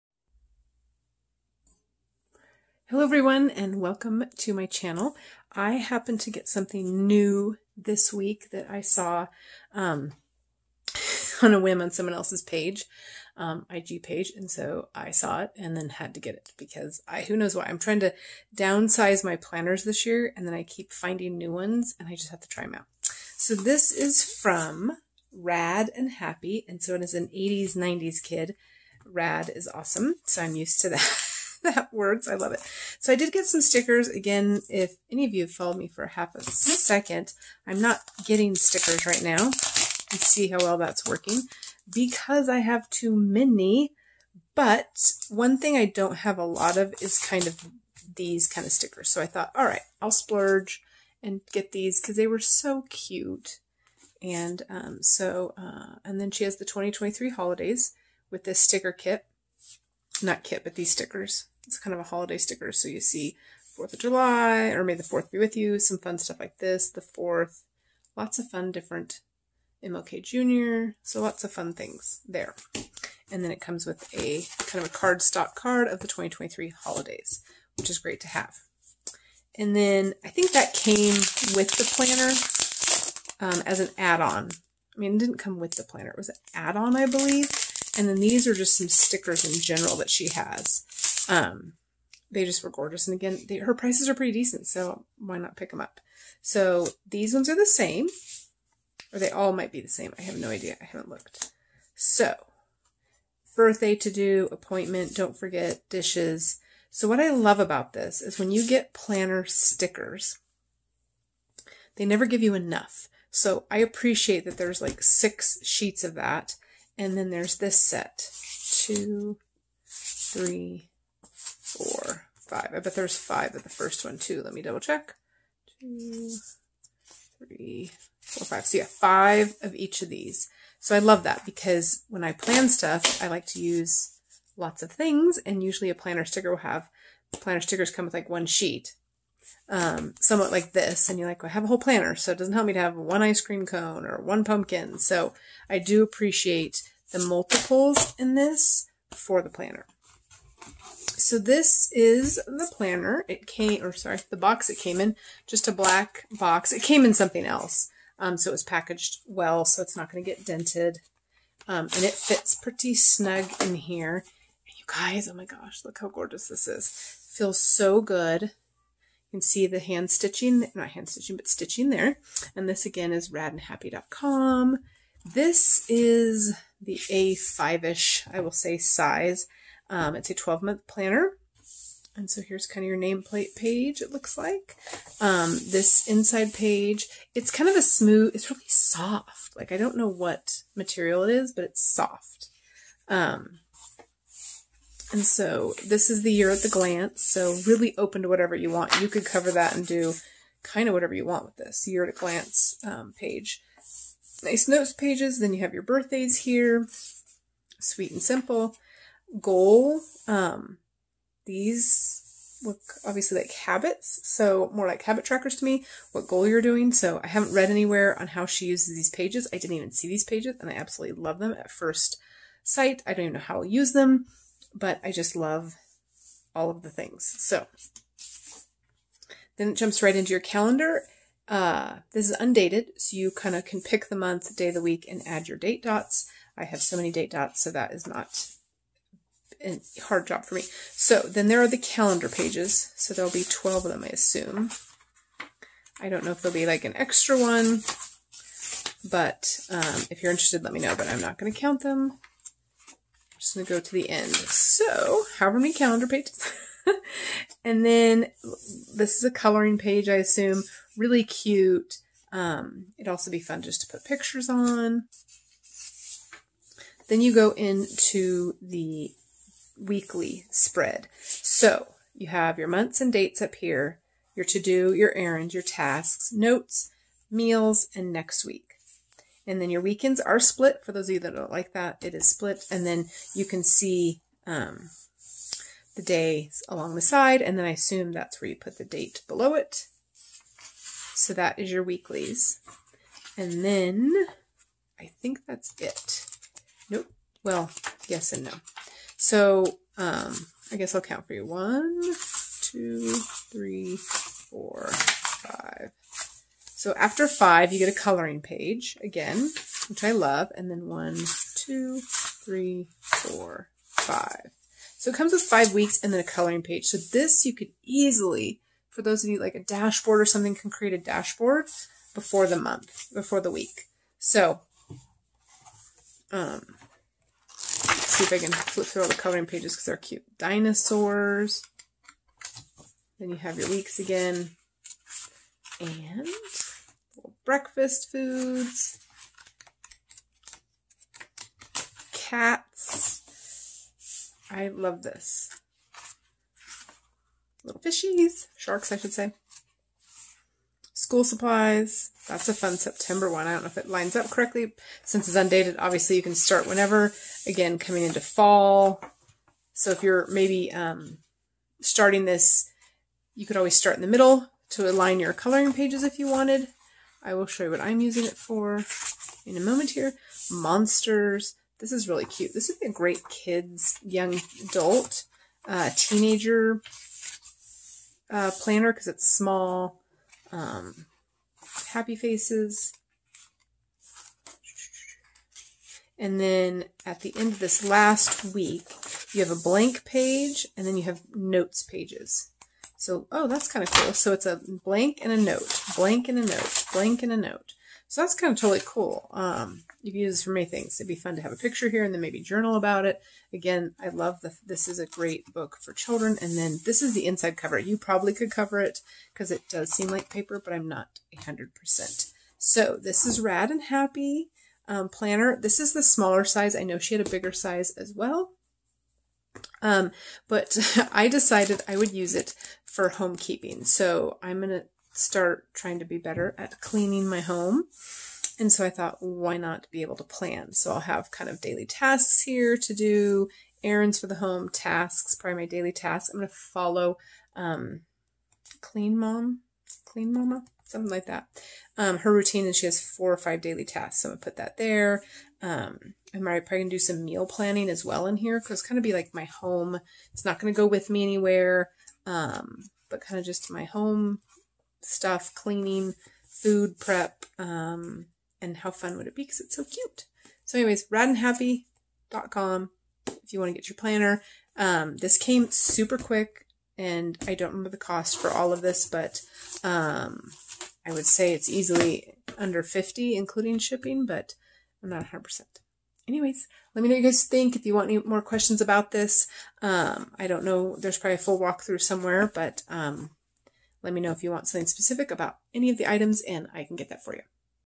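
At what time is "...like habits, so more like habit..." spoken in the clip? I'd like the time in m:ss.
3:33.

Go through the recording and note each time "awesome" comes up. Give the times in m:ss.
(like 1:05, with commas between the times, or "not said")
0:29.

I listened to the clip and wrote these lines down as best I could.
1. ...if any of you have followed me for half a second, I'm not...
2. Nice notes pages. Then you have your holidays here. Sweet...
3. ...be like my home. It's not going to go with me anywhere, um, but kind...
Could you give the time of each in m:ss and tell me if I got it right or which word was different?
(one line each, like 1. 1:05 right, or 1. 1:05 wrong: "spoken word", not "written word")
1. 0:34 right
2. 3:24 wrong: "birthdays", not "holidays"
3. 7:29 right.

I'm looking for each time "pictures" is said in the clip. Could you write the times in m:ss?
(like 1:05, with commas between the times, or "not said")
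4:24, 6:41.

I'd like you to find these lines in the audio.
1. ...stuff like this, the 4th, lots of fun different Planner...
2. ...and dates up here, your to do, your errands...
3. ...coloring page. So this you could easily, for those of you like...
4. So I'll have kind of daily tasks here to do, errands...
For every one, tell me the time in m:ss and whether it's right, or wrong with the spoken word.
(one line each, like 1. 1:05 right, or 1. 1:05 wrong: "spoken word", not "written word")
1. 1:06 wrong: "MLK", not "Planner"
2. 4:33 right
3. 5:16 right
4. 7:10 right.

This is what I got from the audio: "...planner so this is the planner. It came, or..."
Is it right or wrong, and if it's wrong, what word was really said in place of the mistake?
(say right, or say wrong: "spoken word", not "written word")
right.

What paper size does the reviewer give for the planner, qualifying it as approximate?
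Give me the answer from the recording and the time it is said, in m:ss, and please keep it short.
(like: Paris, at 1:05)
A5, at 2:57.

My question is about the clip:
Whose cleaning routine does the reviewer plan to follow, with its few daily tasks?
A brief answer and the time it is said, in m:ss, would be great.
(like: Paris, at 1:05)
Clean Mama, at 7:20.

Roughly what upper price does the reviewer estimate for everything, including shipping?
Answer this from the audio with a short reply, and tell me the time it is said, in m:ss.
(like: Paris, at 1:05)
Under 50, at 7:52.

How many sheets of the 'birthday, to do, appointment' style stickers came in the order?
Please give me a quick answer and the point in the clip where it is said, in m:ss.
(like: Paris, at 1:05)
6, at 1:55.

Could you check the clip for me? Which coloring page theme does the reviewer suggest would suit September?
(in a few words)
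School supplies.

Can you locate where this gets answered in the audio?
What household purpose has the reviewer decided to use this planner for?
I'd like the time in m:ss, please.
7:03.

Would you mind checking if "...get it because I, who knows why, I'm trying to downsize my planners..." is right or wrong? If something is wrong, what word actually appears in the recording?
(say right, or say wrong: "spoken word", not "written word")
right.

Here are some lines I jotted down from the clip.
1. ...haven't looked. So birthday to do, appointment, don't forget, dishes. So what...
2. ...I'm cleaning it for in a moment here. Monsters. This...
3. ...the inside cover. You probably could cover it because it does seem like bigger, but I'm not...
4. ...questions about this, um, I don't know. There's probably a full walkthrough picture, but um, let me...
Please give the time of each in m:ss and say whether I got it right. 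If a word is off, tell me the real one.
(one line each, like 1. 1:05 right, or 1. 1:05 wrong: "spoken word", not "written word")
1. 1:40 right
2. 6:07 wrong: "using", not "cleaning"
3. 6:47 wrong: "paper", not "bigger"
4. 7:58 wrong: "somewhere", not "picture".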